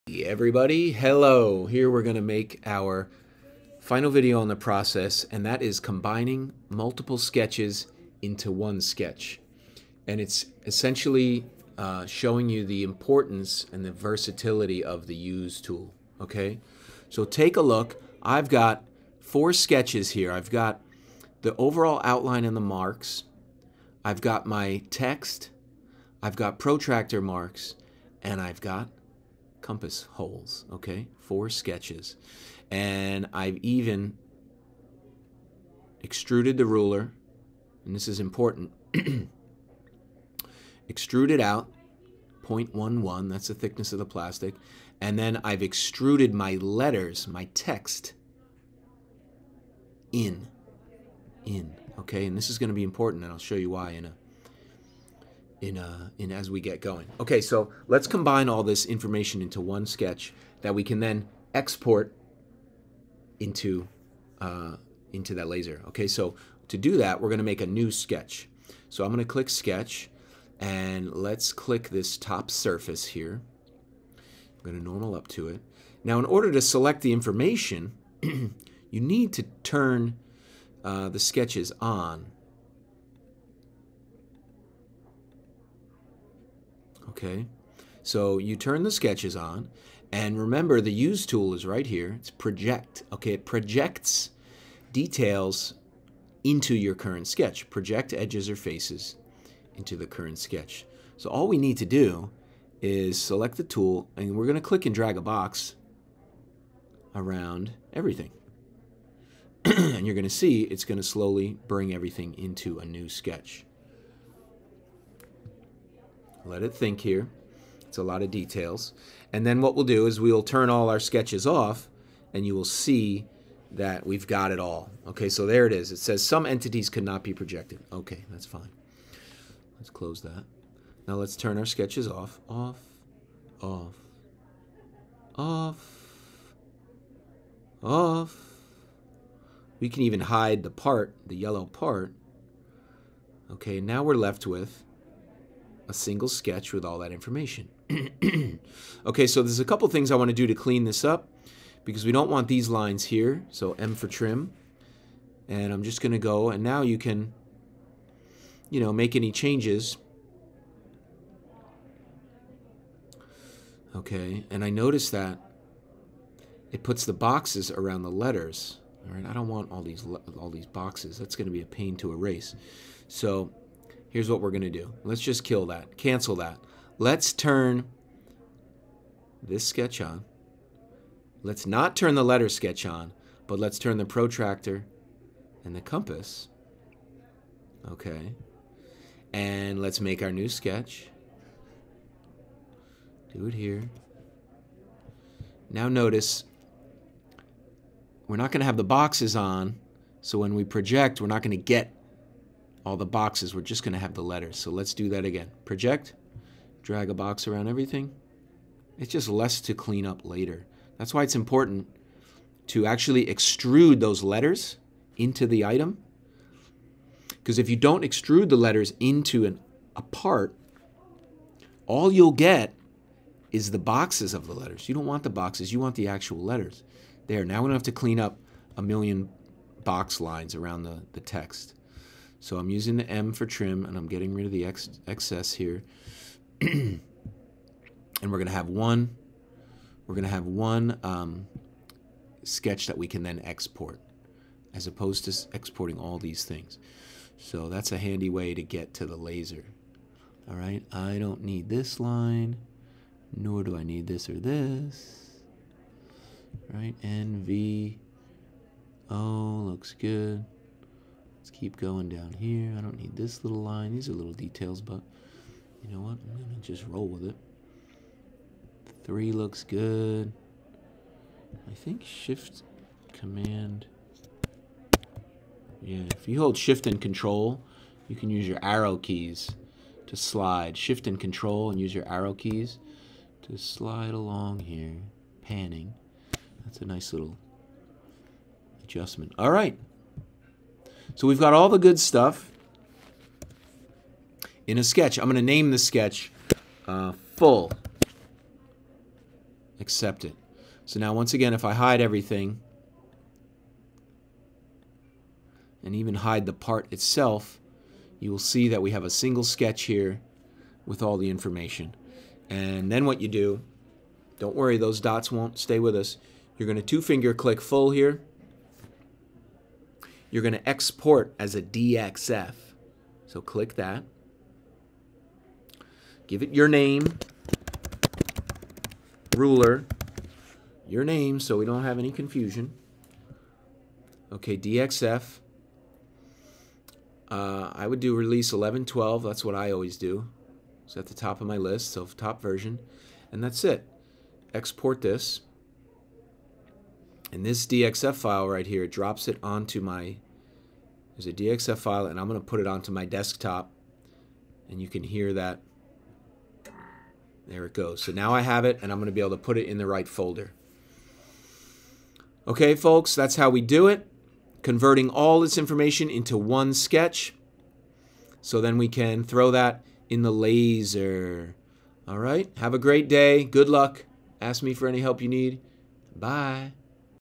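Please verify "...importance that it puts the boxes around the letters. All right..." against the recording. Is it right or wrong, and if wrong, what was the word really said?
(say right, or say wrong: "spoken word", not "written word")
wrong: "notice", not "importance".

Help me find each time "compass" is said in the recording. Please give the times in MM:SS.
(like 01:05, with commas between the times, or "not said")
00:29, 03:05.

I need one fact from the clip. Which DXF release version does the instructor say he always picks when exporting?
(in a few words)
11.12.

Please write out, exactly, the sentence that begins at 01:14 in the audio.
I'm gonna normal up to it.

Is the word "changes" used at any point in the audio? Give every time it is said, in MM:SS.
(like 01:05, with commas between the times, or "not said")
02:39.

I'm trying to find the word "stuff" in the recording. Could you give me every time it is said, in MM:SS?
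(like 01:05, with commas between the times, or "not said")
04:51.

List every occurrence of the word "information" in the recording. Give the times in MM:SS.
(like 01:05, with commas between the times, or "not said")
00:58, 01:17, 02:27, 05:11, 06:05.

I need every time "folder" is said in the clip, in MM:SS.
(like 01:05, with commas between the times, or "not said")
06:00.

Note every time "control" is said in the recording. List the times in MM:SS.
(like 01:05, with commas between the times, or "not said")
04:37, 04:41.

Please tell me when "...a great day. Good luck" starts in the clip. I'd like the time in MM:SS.
06:12.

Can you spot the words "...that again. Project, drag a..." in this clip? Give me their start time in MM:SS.
03:25.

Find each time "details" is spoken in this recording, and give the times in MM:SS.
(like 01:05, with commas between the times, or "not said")
01:34, 01:58, 04:24.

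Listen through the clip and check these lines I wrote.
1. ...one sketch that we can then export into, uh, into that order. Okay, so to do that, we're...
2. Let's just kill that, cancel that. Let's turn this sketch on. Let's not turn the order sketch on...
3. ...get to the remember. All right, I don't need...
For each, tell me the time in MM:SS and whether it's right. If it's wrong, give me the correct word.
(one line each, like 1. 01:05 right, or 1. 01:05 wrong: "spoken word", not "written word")
1. 00:59 wrong: "laser", not "order"
2. 02:55 wrong: "letter", not "order"
3. 04:08 wrong: "laser", not "remember".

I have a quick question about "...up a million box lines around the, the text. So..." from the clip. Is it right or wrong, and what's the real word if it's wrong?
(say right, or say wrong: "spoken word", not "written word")
right.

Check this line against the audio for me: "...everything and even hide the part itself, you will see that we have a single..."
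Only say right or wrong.
right.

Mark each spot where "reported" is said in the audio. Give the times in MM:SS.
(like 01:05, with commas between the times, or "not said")
not said.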